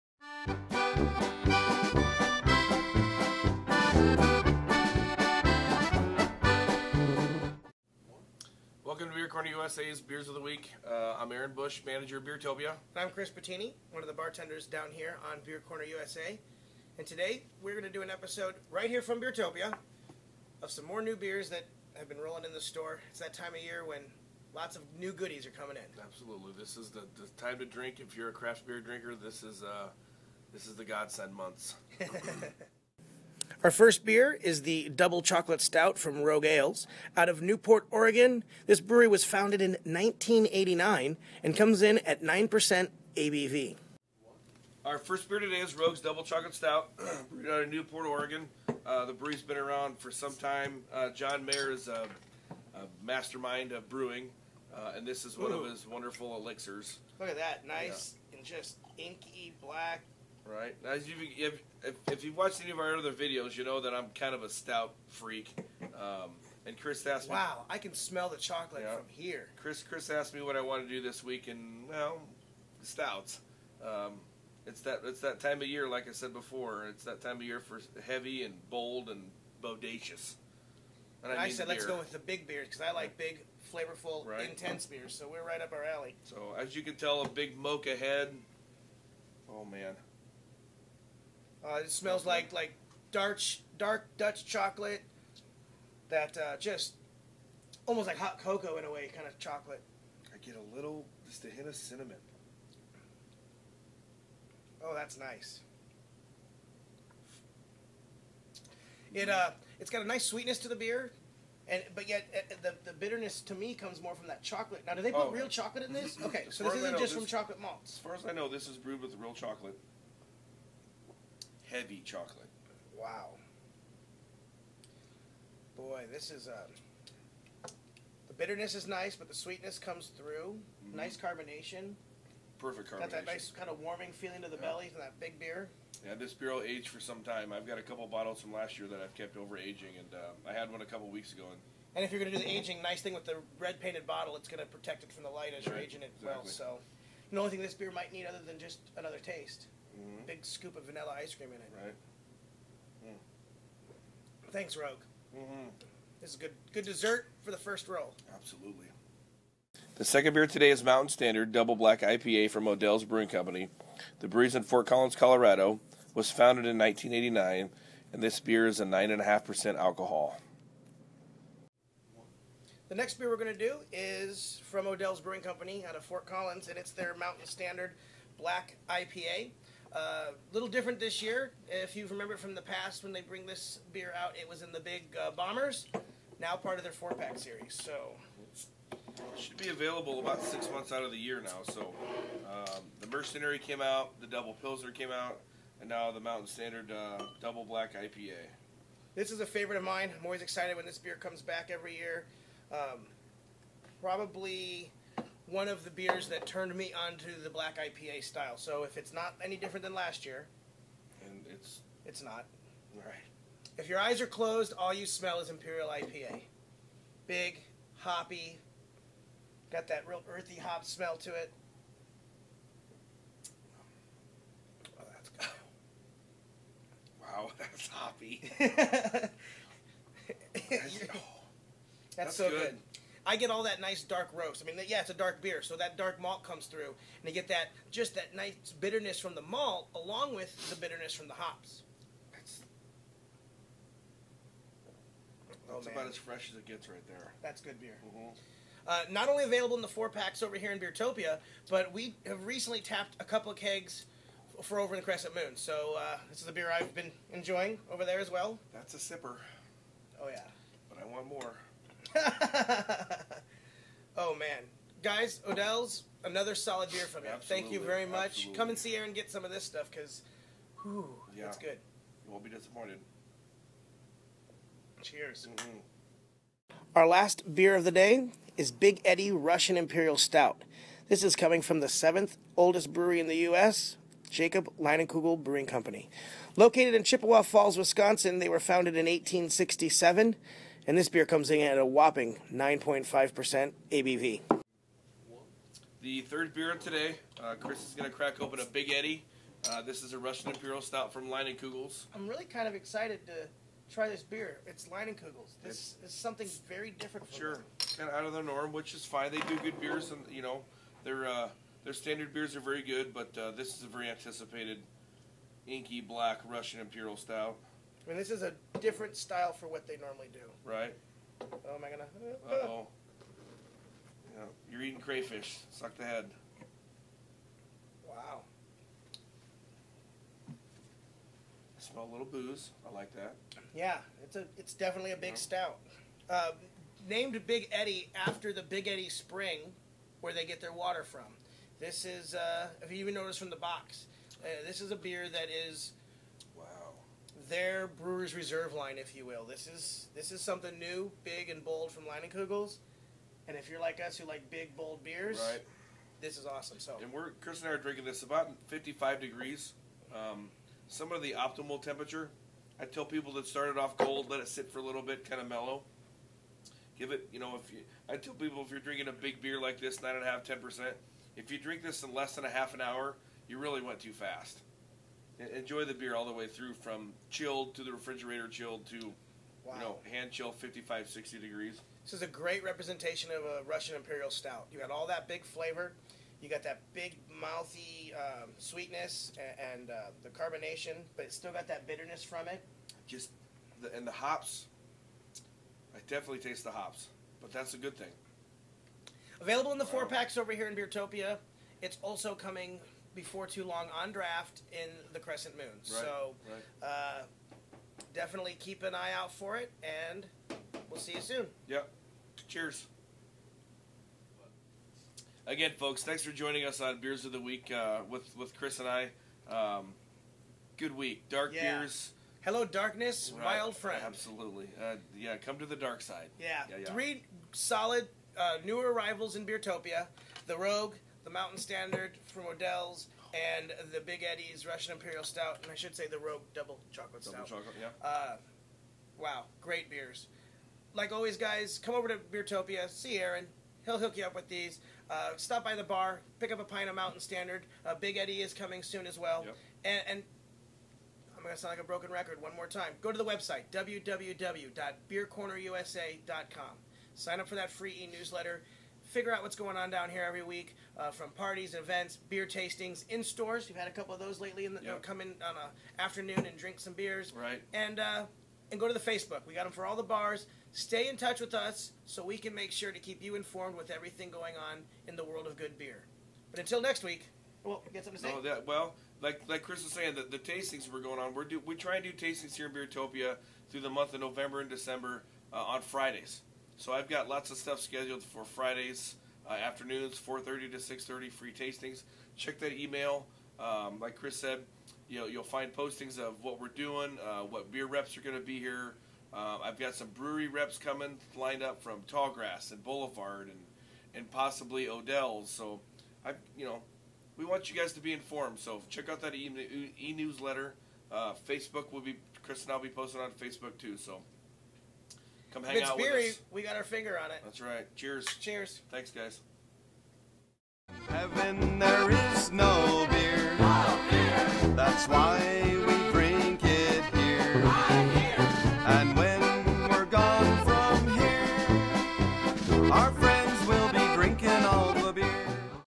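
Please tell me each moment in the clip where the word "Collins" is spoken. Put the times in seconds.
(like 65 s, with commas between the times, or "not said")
164 s, 176 s.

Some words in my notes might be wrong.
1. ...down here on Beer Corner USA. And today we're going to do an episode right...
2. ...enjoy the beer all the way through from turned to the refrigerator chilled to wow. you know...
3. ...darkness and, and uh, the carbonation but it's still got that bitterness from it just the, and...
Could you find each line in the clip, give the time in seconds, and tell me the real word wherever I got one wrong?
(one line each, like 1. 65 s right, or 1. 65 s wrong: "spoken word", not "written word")
1. 14 s right
2. 375 s wrong: "chilled", not "turned"
3. 388 s wrong: "sweetness", not "darkness".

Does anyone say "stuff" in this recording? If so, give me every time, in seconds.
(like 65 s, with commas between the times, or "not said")
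269 s, 487 s.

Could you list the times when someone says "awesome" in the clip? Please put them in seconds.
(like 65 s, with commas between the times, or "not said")
356 s.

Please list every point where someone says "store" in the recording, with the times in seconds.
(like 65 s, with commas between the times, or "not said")
22 s, 463 s.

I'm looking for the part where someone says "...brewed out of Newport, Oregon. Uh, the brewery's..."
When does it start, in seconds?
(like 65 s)
47 s.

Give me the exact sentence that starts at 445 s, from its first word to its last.
Uh, stop by the bar, pick up a pint of Mountain Standard.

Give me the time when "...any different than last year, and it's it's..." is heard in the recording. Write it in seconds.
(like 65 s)
209 s.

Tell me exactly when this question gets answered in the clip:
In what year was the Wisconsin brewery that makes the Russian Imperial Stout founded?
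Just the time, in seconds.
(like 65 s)
289 s.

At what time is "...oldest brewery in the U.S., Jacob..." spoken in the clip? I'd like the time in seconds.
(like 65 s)
282 s.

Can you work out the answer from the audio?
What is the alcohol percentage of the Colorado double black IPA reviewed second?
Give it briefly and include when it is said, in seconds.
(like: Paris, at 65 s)
9.5%, at 168 s.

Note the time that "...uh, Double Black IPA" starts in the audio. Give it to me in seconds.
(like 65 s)
196 s.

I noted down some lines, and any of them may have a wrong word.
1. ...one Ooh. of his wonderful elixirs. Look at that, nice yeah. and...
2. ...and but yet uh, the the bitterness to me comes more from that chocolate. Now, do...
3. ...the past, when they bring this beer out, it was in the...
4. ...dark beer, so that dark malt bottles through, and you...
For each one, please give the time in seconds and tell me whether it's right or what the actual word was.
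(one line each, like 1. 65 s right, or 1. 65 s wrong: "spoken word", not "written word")
1. 55 s right
2. 111 s right
3. 182 s right
4. 235 s wrong: "comes", not "bottles".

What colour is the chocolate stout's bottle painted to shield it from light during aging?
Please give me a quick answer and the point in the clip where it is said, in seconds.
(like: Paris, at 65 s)
Red, at 143 s.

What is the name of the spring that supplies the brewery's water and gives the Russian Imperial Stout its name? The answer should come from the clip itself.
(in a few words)
Big Eddy Spring.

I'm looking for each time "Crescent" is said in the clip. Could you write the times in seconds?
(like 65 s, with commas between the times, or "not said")
255 s, 405 s.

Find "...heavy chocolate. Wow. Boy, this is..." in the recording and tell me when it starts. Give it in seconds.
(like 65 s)
121 s.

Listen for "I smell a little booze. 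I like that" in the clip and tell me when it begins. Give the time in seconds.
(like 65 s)
330 s.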